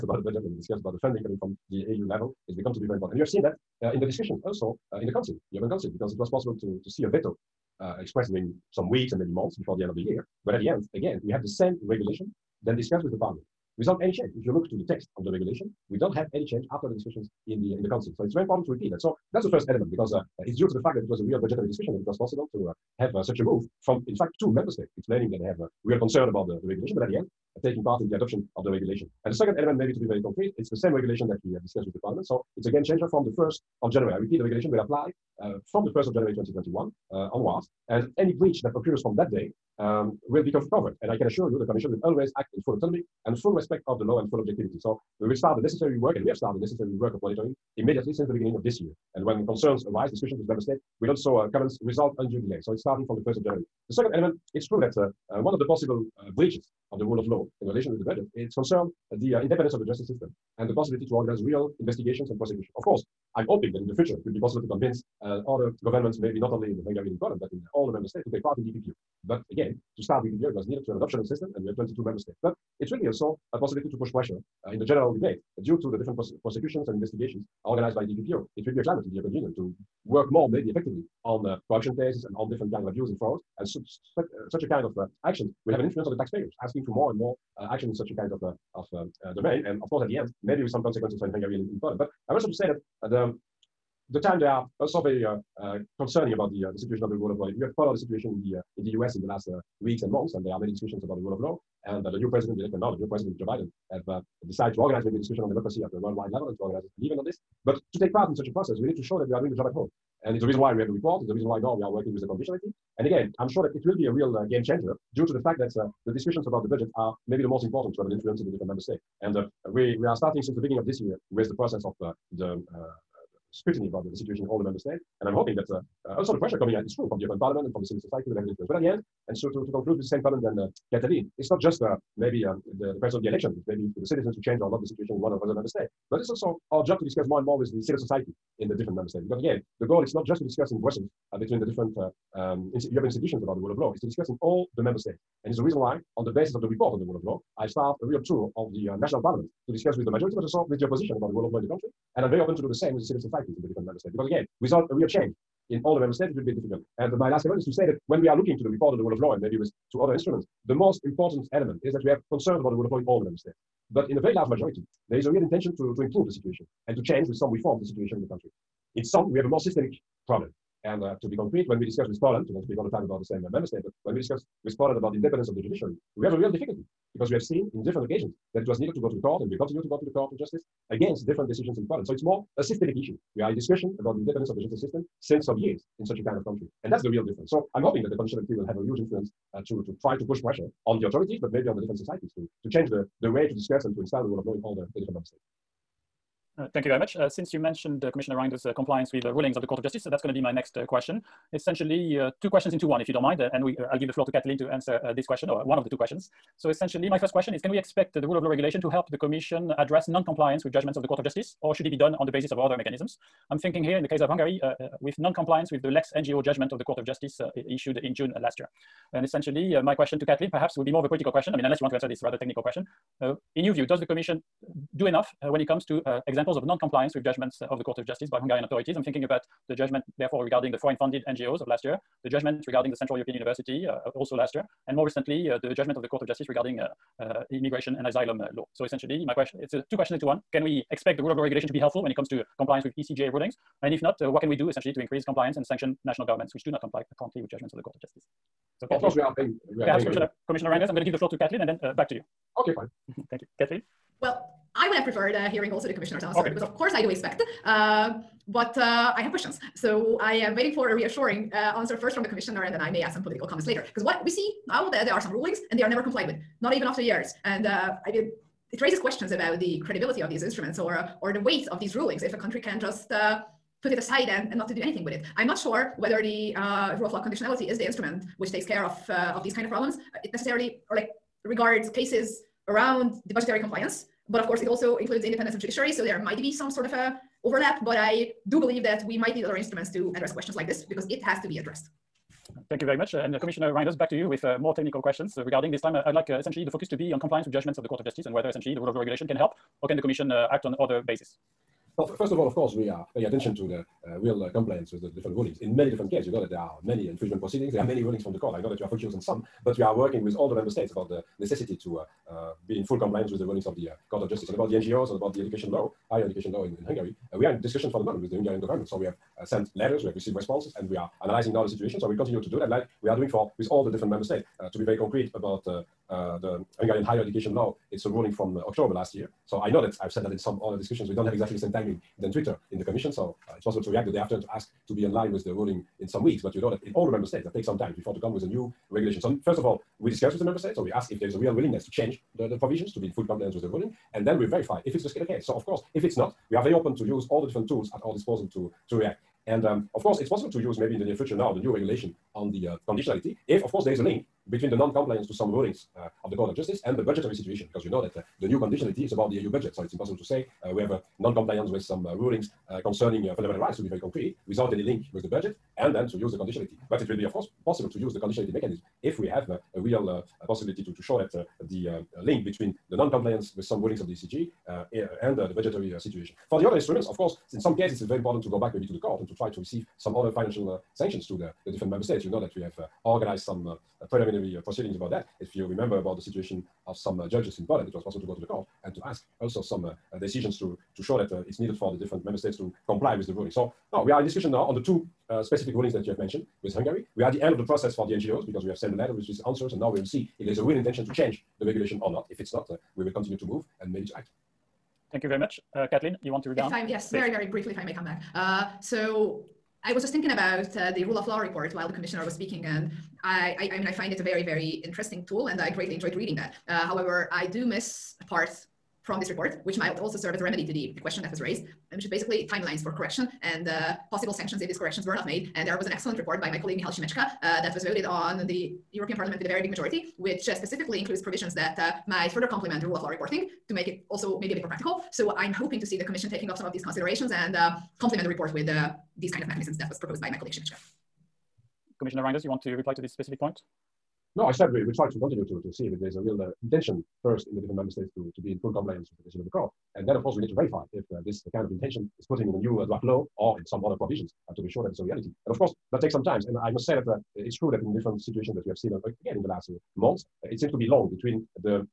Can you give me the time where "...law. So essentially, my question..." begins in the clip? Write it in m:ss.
3:58.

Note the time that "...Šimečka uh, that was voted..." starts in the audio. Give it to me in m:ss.
7:06.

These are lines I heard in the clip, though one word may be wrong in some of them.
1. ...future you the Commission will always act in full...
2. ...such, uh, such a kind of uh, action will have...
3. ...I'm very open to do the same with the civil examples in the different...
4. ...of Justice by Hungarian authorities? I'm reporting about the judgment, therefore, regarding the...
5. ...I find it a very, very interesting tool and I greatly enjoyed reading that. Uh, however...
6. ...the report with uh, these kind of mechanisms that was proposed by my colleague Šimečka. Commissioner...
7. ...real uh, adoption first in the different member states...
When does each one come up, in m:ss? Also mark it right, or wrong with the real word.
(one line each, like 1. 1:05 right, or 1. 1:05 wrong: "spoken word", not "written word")
1. 0:41 wrong: "assure", not "future"
2. 1:24 right
3. 2:32 wrong: "societies", not "examples"
4. 3:47 wrong: "thinking", not "reporting"
5. 6:53 right
6. 7:18 right
7. 7:26 wrong: "intention", not "adoption".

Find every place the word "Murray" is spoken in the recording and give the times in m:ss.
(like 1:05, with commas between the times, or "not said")
not said.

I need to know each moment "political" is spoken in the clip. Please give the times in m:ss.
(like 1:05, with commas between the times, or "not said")
3:41, 4:23.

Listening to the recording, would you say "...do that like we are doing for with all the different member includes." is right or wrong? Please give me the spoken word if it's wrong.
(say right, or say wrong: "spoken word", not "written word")
wrong: "states", not "includes".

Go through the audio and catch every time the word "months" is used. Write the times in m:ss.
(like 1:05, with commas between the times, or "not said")
0:09, 1:40, 7:39.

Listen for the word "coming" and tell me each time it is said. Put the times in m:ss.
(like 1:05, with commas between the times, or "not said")
0:01, 2:06.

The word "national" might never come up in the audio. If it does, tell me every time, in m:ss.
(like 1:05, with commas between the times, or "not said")
2:28, 4:06.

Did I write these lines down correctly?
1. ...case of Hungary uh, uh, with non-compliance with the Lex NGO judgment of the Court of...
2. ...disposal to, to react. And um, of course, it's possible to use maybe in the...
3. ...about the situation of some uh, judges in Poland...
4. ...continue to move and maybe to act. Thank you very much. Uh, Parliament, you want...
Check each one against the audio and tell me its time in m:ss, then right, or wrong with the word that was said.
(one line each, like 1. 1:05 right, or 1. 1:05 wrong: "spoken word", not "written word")
1. 3:34 right
2. 5:48 right
3. 6:25 right
4. 6:43 wrong: "Katalin", not "Parliament".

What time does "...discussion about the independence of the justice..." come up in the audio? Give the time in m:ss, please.
3:03.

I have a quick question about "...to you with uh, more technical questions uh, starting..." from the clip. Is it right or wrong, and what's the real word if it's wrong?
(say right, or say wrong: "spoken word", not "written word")
wrong: "regarding", not "starting".